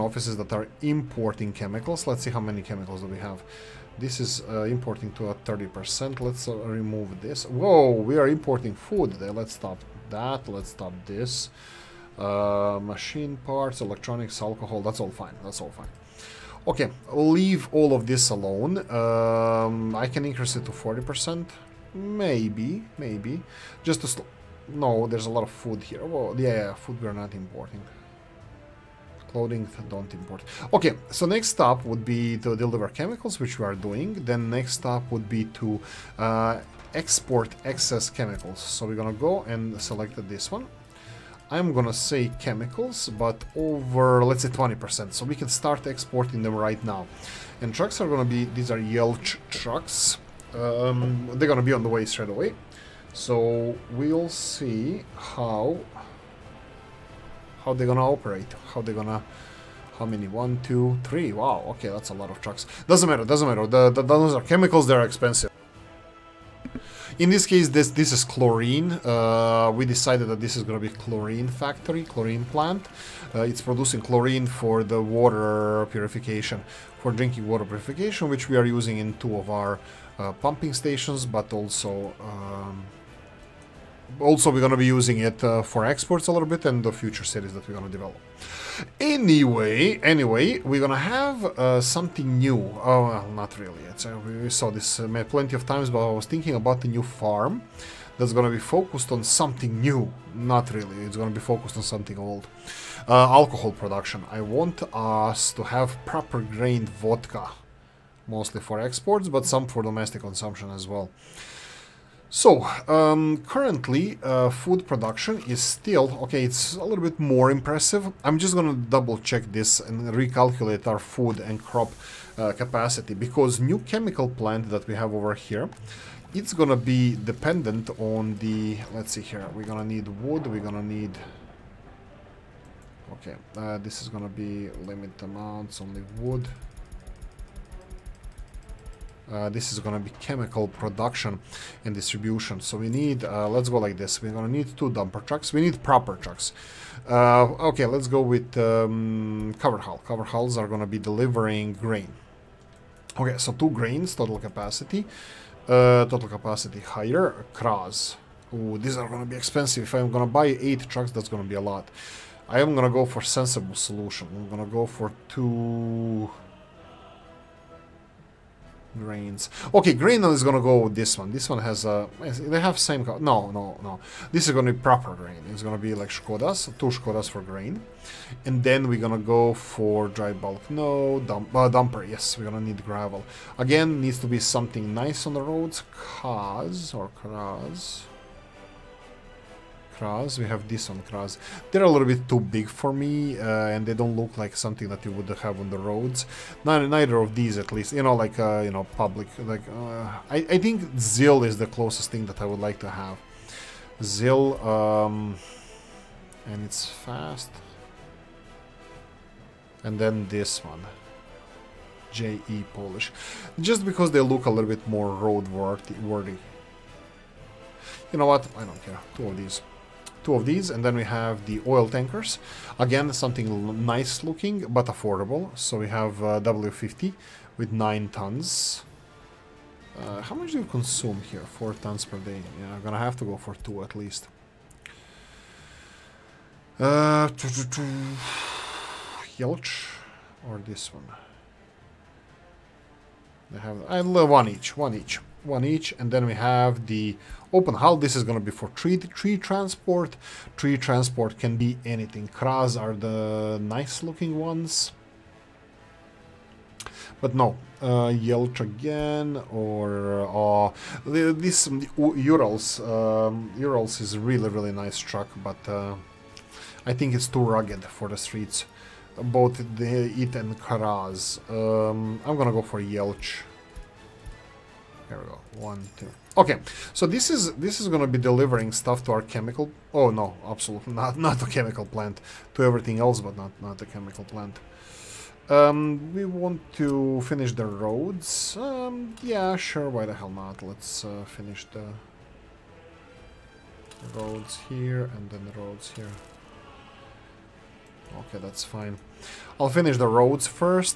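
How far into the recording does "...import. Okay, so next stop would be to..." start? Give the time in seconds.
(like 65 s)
30 s.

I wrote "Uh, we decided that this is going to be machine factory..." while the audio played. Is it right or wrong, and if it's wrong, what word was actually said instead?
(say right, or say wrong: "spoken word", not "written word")
wrong: "chlorine", not "machine".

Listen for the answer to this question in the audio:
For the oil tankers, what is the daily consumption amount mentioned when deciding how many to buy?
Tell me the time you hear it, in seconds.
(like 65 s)
231 s.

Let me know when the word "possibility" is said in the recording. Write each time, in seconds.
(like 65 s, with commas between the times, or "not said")
not said.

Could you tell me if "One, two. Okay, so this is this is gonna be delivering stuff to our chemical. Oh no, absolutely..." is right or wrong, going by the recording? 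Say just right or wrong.
right.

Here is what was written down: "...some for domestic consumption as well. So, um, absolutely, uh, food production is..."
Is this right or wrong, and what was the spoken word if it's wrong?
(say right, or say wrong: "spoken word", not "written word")
wrong: "currently", not "absolutely".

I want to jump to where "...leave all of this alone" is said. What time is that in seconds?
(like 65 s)
17 s.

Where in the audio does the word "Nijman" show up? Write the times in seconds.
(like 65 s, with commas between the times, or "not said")
not said.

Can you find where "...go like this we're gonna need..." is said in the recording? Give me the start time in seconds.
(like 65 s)
143 s.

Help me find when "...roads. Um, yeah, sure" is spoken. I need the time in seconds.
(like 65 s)
287 s.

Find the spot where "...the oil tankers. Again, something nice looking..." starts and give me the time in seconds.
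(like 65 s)
221 s.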